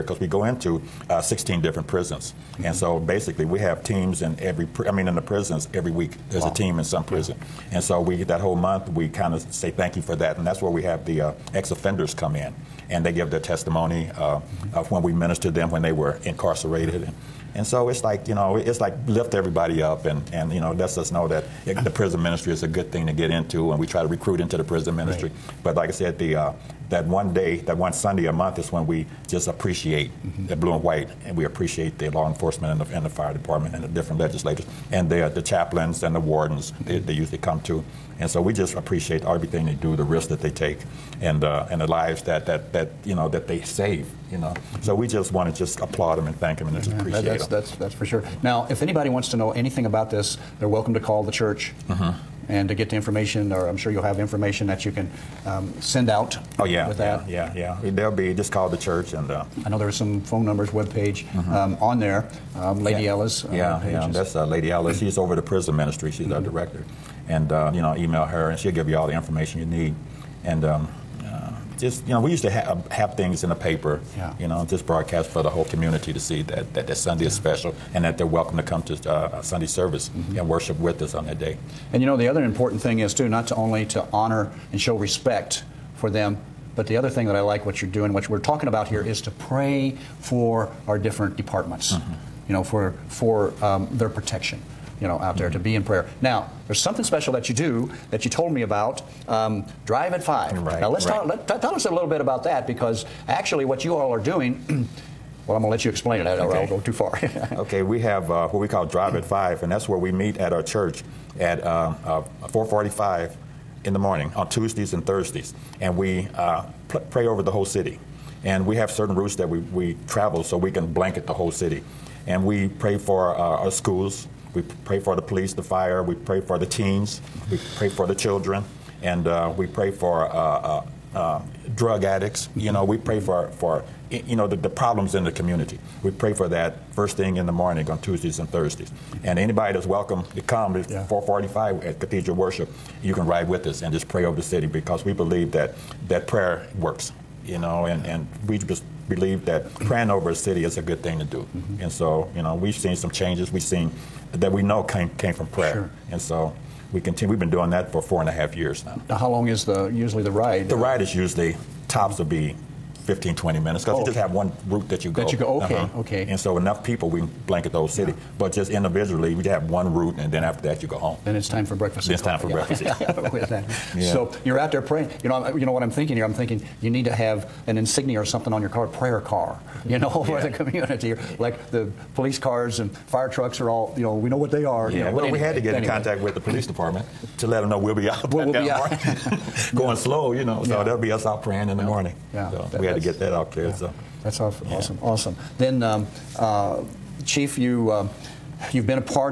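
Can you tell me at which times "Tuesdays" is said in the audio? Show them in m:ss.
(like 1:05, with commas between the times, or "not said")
1:54, 2:18.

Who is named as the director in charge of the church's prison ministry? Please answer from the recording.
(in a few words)
Lady Ellis.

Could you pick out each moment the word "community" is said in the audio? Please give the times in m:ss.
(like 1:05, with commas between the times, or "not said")
1:15, 2:15, 3:00.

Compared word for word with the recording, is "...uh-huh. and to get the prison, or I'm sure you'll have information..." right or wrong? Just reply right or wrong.
wrong.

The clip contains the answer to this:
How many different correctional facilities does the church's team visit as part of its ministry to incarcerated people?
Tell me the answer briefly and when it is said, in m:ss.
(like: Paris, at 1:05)
16, at 0:01.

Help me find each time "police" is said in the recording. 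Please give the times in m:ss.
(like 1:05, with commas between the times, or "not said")
2:05, 3:02, 3:06.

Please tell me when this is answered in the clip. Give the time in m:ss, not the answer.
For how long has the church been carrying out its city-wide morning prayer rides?
2:38.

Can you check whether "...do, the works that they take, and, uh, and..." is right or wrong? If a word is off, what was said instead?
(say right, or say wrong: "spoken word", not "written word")
wrong: "risks", not "works".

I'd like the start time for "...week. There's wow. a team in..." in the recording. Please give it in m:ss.
0:05.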